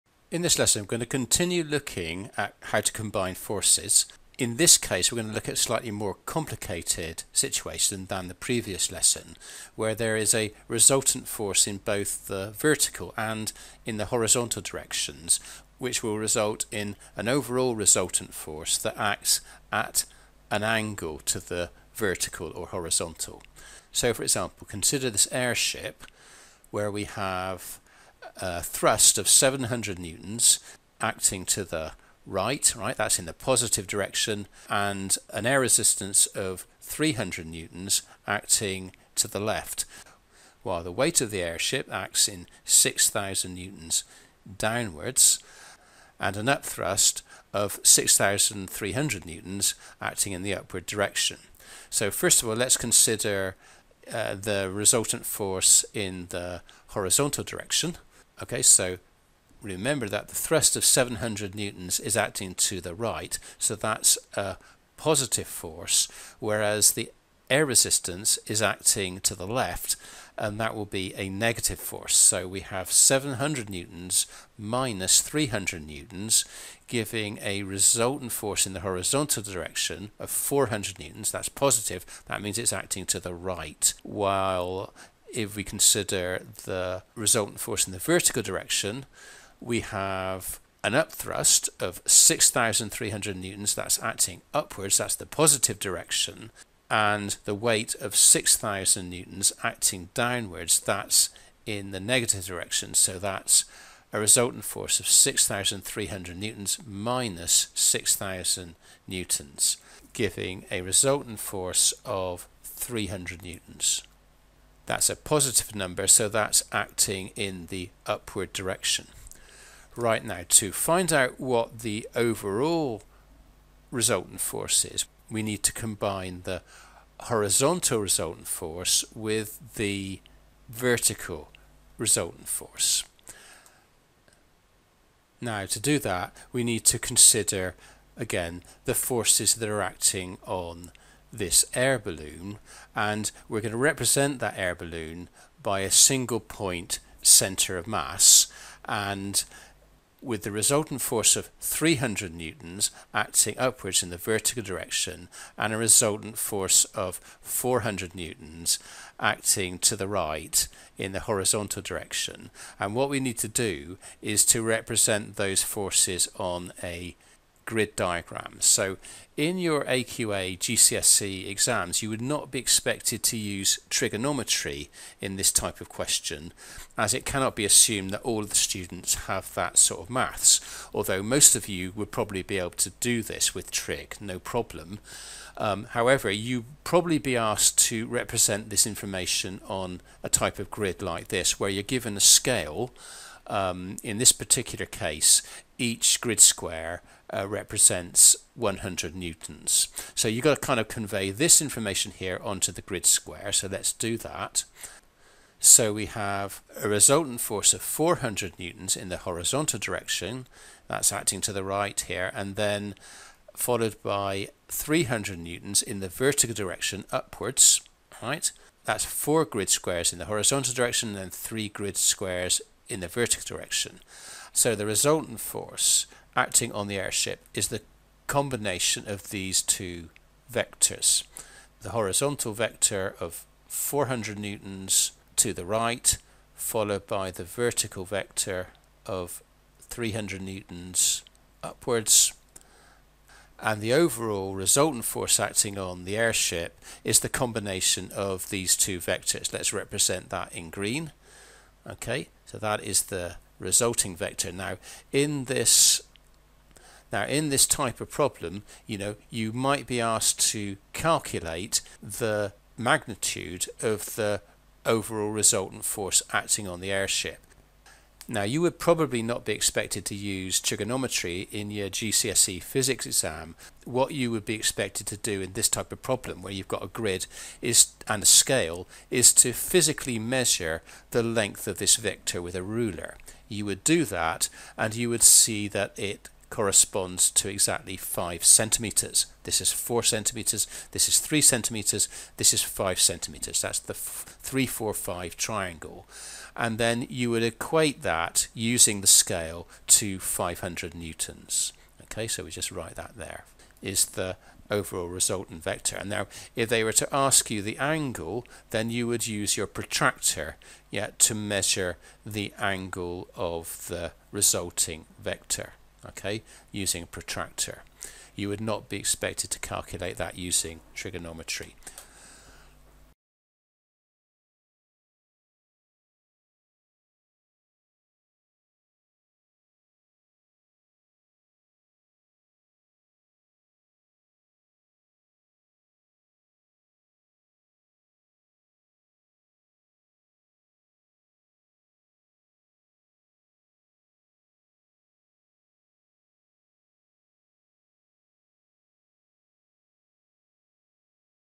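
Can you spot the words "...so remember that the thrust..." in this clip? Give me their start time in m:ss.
0:58.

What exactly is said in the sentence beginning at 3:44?
So the resultant force acting on the airship is the combination of these two vectors.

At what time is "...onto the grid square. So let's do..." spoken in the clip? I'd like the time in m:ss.
3:22.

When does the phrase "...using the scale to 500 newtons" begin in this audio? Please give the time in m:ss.
4:58.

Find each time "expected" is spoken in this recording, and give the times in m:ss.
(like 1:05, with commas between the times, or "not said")
2:52, 4:29, 4:34, 5:18.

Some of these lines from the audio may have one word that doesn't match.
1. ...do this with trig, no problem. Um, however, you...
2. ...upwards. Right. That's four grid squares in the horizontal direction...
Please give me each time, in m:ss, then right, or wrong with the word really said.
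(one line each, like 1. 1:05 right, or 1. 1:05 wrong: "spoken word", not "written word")
1. 3:02 right
2. 3:37 right.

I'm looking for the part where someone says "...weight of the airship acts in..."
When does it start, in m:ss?
0:40.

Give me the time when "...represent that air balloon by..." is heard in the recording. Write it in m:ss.
2:23.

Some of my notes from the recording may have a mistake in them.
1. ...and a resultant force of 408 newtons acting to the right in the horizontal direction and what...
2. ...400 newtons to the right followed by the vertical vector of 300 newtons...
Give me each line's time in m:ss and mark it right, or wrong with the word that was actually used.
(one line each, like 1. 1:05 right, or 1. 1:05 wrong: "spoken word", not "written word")
1. 2:35 wrong: "400", not "408"
2. 3:53 right.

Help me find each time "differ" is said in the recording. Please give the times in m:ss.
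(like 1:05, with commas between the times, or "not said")
not said.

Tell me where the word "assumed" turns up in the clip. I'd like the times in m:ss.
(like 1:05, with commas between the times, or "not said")
2:57.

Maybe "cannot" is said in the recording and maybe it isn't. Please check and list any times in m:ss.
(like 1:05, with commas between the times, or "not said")
2:57.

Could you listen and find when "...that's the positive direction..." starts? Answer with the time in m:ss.
1:34.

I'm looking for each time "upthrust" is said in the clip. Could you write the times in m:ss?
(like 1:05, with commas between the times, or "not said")
0:46, 1:30.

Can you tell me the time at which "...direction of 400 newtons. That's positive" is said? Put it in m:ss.
1:19.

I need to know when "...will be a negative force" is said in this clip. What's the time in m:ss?
1:10.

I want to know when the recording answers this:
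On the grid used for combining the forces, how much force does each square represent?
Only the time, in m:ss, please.
3:18.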